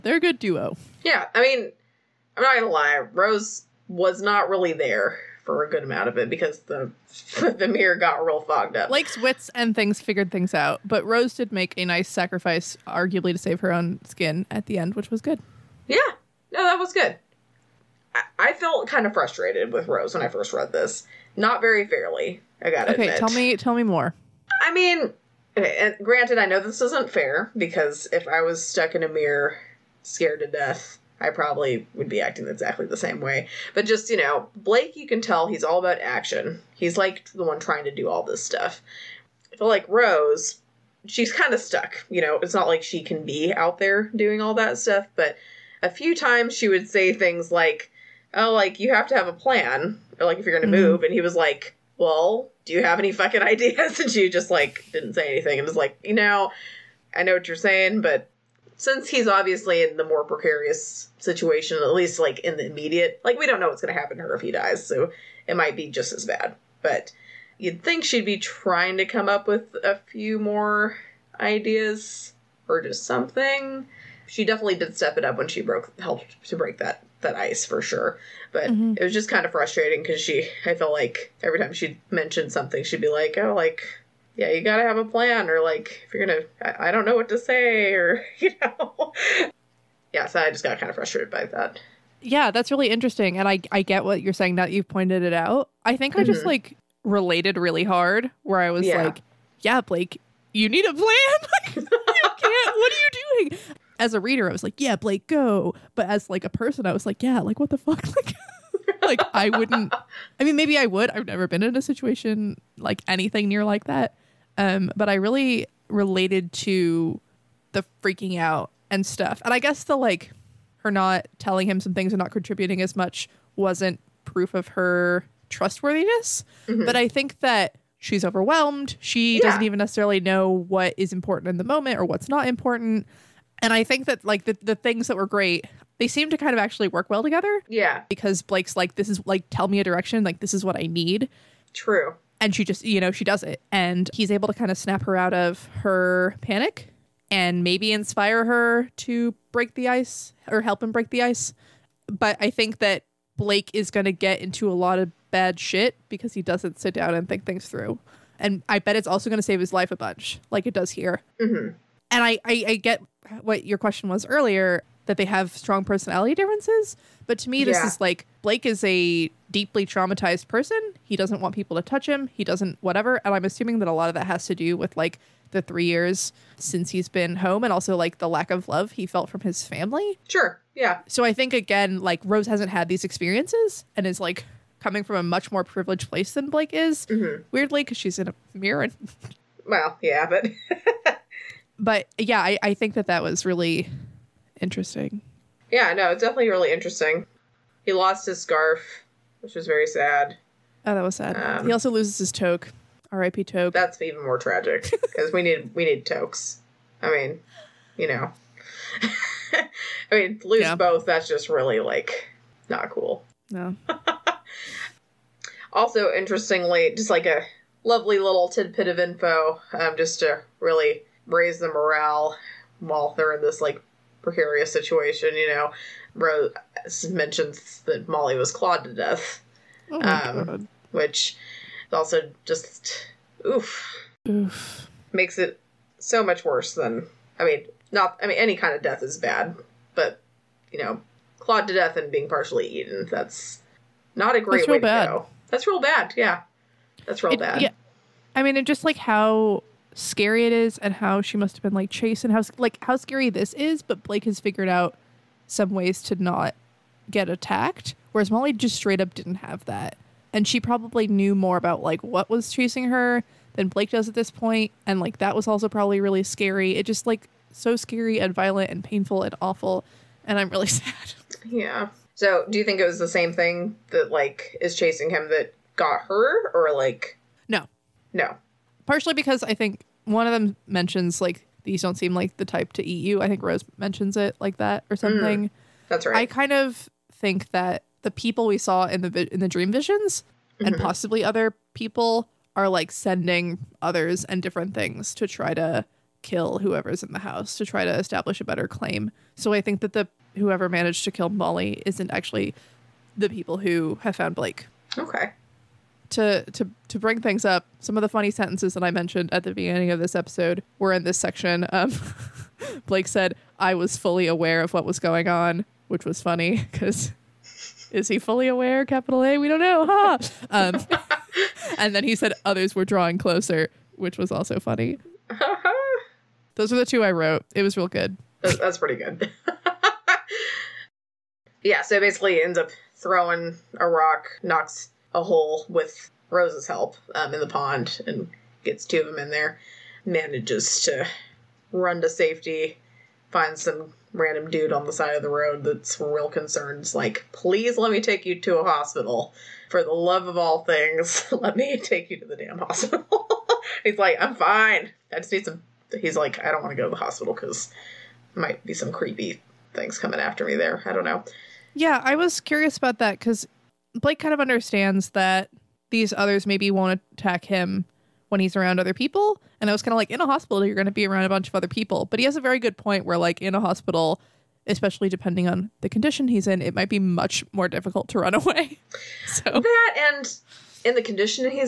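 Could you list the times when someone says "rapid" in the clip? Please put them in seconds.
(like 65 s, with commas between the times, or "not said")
not said.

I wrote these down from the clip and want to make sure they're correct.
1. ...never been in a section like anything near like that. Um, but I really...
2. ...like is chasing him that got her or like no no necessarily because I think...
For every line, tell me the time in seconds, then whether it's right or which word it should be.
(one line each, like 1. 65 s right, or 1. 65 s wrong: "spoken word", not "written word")
1. 111 s wrong: "situation", not "section"
2. 274 s wrong: "partially", not "necessarily".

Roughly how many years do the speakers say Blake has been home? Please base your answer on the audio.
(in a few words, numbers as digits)
3.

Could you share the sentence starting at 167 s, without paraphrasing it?
is like Blake is a deeply traumatized person.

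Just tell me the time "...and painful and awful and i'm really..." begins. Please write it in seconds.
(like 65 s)
268 s.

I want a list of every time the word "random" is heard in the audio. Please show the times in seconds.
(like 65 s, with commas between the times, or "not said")
344 s.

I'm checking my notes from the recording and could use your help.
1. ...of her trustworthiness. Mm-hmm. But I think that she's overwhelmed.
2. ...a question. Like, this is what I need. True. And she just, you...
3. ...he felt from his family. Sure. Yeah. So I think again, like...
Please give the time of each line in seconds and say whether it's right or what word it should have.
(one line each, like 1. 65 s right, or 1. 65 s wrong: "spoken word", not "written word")
1. 124 s right
2. 139 s wrong: "direction", not "question"
3. 178 s right.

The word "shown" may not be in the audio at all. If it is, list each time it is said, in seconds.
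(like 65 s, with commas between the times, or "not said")
not said.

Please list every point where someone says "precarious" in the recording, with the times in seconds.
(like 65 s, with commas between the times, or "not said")
60 s, 224 s.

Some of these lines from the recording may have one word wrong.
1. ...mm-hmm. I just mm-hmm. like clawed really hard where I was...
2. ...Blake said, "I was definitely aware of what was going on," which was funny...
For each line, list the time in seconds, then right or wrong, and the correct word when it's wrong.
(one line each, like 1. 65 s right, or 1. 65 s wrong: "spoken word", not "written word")
1. 96 s wrong: "related", not "clawed"
2. 312 s wrong: "fully", not "definitely".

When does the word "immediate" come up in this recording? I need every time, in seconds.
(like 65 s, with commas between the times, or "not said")
62 s.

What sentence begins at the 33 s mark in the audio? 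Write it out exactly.
But just, you know, Blake, you can tell he's all about action.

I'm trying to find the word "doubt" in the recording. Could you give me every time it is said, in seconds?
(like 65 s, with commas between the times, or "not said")
not said.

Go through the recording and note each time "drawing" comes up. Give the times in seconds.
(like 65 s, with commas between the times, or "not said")
322 s.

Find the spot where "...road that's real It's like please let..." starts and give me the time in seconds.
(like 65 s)
345 s.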